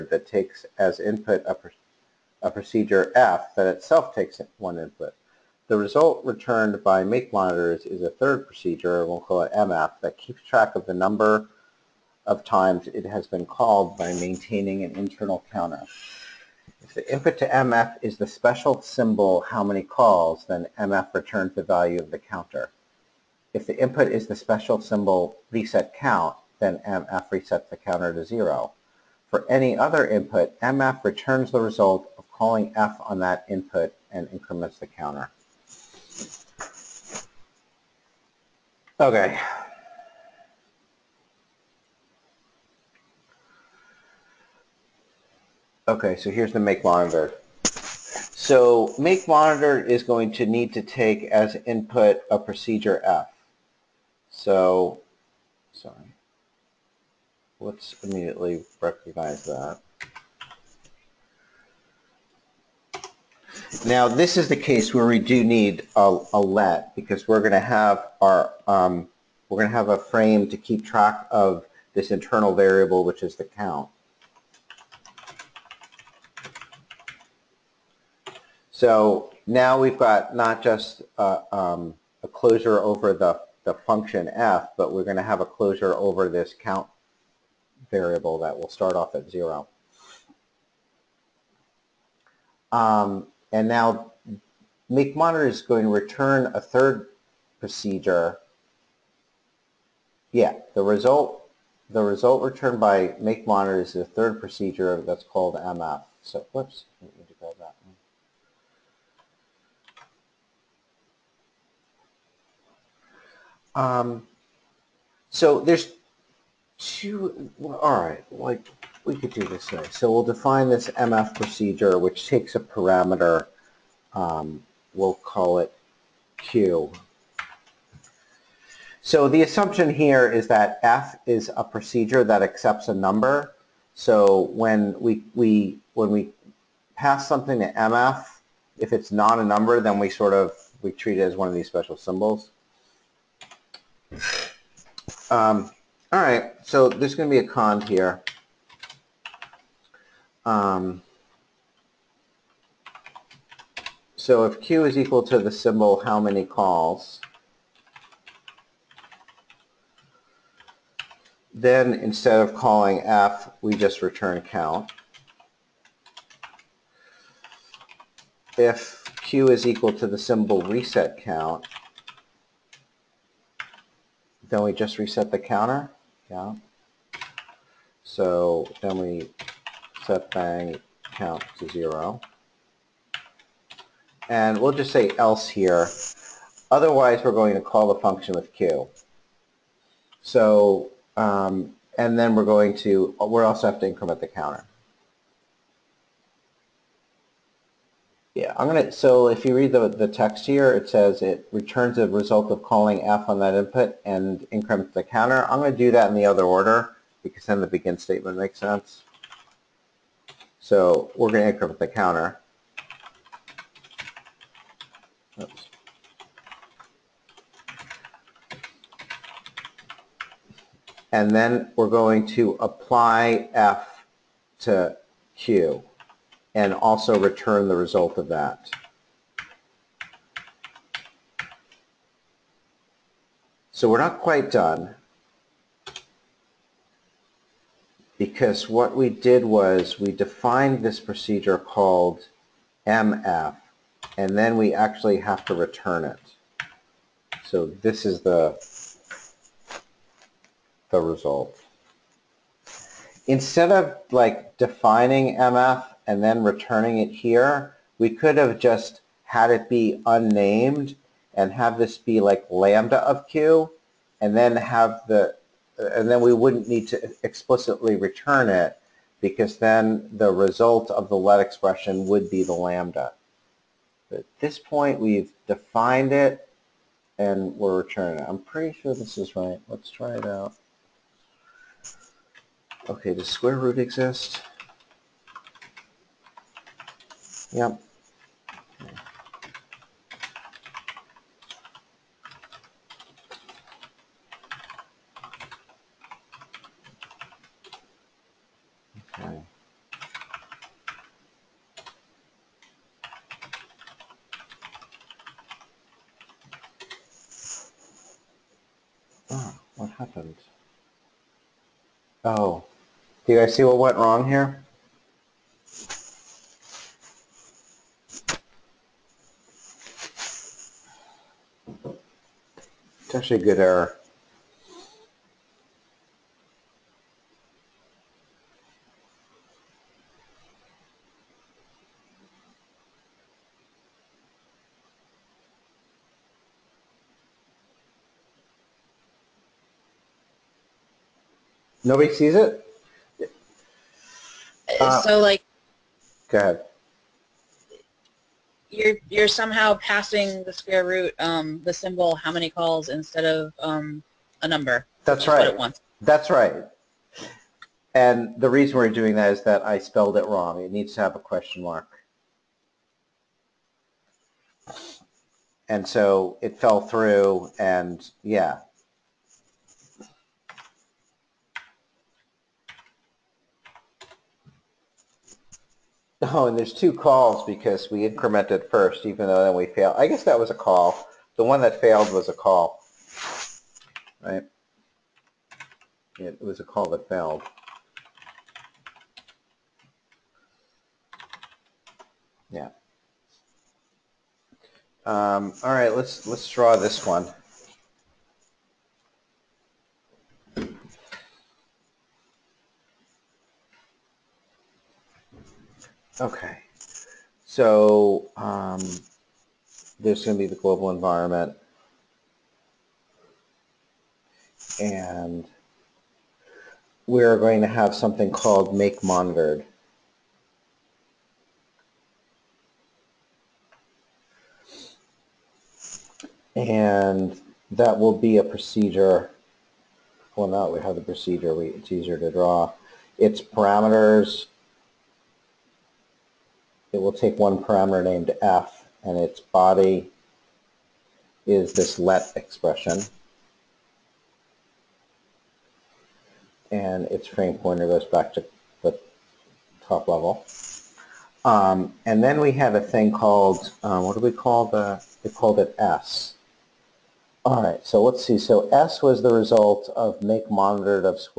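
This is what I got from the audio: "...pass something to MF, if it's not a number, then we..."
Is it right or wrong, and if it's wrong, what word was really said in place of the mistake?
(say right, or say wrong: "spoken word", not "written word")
right.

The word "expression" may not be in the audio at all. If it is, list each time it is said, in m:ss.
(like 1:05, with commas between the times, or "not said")
4:31, 7:22.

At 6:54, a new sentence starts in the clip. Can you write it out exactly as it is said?
And we're going to have something called make monitored.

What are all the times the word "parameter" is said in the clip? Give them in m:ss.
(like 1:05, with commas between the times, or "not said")
2:02, 7:13, 7:17.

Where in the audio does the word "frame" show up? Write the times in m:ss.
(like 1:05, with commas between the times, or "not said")
1:09, 7:27.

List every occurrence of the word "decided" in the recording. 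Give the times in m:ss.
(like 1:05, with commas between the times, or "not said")
not said.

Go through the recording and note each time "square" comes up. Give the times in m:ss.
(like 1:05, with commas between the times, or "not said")
4:43, 5:50.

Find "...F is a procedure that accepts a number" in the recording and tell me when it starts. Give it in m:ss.
2:10.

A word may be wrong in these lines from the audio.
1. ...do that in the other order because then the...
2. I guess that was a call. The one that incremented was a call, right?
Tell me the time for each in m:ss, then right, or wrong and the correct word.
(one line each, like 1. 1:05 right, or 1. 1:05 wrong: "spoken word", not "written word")
1. 3:25 right
2. 6:19 wrong: "failed", not "incremented".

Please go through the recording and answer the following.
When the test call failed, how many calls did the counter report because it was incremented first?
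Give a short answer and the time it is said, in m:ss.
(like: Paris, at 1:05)
2, at 6:16.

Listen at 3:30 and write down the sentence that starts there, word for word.
So we're going to increment the counter.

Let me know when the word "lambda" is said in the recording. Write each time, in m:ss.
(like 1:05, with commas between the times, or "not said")
4:22, 4:32.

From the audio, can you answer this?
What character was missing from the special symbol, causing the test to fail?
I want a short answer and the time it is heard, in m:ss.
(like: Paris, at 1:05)
question mark, at 6:01.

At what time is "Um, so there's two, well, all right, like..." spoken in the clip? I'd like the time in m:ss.
1:53.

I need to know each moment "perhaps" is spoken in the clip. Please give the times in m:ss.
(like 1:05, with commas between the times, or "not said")
not said.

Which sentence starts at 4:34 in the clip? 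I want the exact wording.
But at this point, we've defined it, and we're returning it.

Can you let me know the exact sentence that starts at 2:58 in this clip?
So then we set bang count to zero.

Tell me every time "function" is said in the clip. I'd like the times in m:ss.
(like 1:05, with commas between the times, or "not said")
1:23, 3:07.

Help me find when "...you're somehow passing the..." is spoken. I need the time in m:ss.
5:49.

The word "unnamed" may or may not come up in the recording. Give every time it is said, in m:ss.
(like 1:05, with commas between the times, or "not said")
4:20.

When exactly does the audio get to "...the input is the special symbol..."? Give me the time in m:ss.
0:23.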